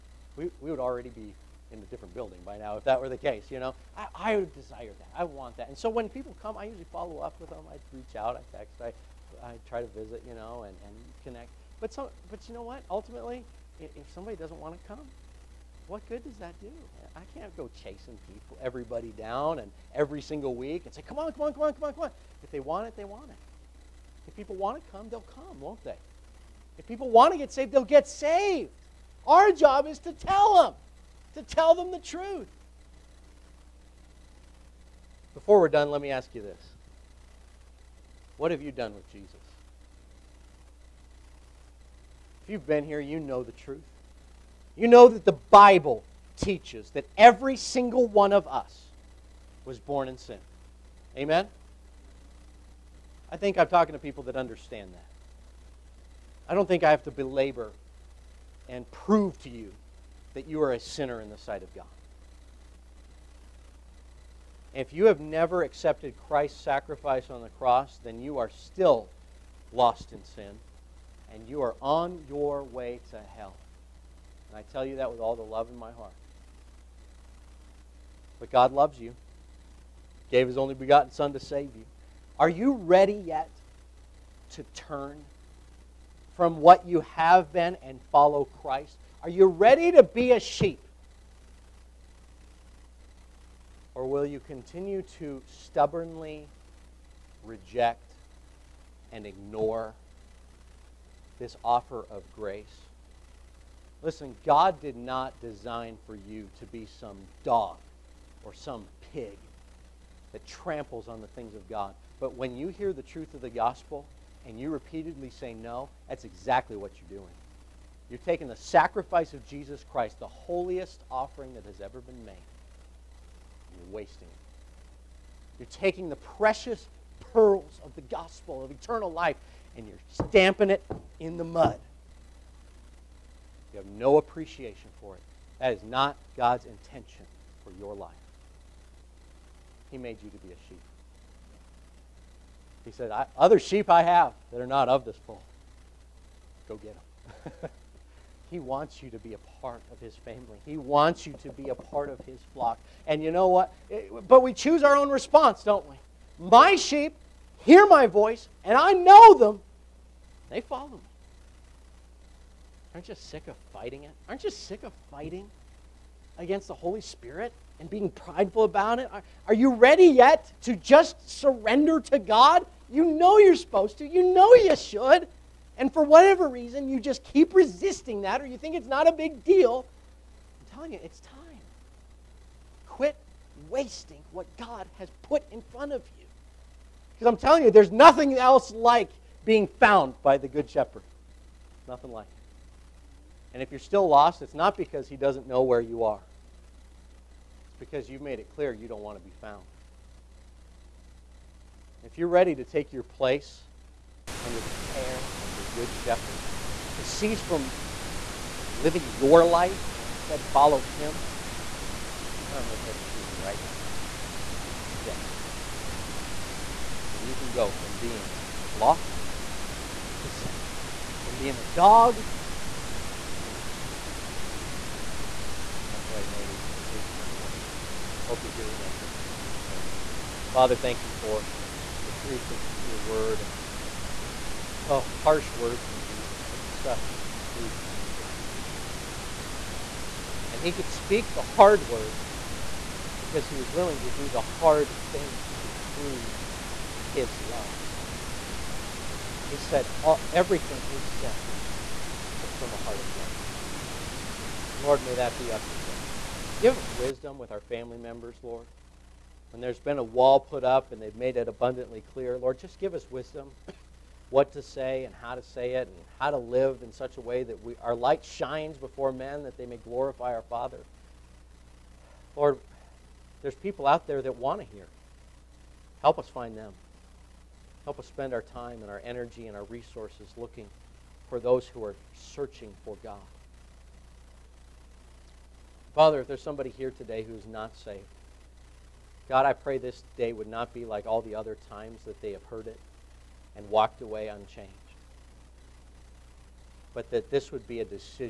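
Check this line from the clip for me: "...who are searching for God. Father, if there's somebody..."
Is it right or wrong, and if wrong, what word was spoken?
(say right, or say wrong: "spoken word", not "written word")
right.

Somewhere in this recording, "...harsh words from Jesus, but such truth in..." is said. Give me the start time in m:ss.
3:55.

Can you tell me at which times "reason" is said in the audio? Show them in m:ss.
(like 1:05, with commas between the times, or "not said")
2:56.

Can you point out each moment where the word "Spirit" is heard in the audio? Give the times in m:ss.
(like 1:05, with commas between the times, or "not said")
2:47.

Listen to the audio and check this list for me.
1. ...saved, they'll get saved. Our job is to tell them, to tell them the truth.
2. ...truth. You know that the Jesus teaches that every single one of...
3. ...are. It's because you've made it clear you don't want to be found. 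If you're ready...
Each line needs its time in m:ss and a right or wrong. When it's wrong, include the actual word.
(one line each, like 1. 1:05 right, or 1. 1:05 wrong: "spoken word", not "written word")
1. 0:27 right
2. 0:43 wrong: "Bible", not "Jesus"
3. 3:16 right.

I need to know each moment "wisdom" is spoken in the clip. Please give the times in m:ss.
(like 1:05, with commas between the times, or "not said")
4:16, 4:23.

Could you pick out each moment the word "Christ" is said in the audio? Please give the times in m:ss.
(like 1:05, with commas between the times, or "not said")
1:06, 1:28, 1:59.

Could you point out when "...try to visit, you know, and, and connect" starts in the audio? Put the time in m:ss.
0:09.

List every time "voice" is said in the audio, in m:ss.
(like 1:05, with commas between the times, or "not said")
2:38.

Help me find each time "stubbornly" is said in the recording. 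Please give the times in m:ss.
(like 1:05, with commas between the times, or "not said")
1:35.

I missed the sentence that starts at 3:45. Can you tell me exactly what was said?
That's why he made each, each and every one of us.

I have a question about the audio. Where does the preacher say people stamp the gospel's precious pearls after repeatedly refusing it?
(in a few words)
In the mud.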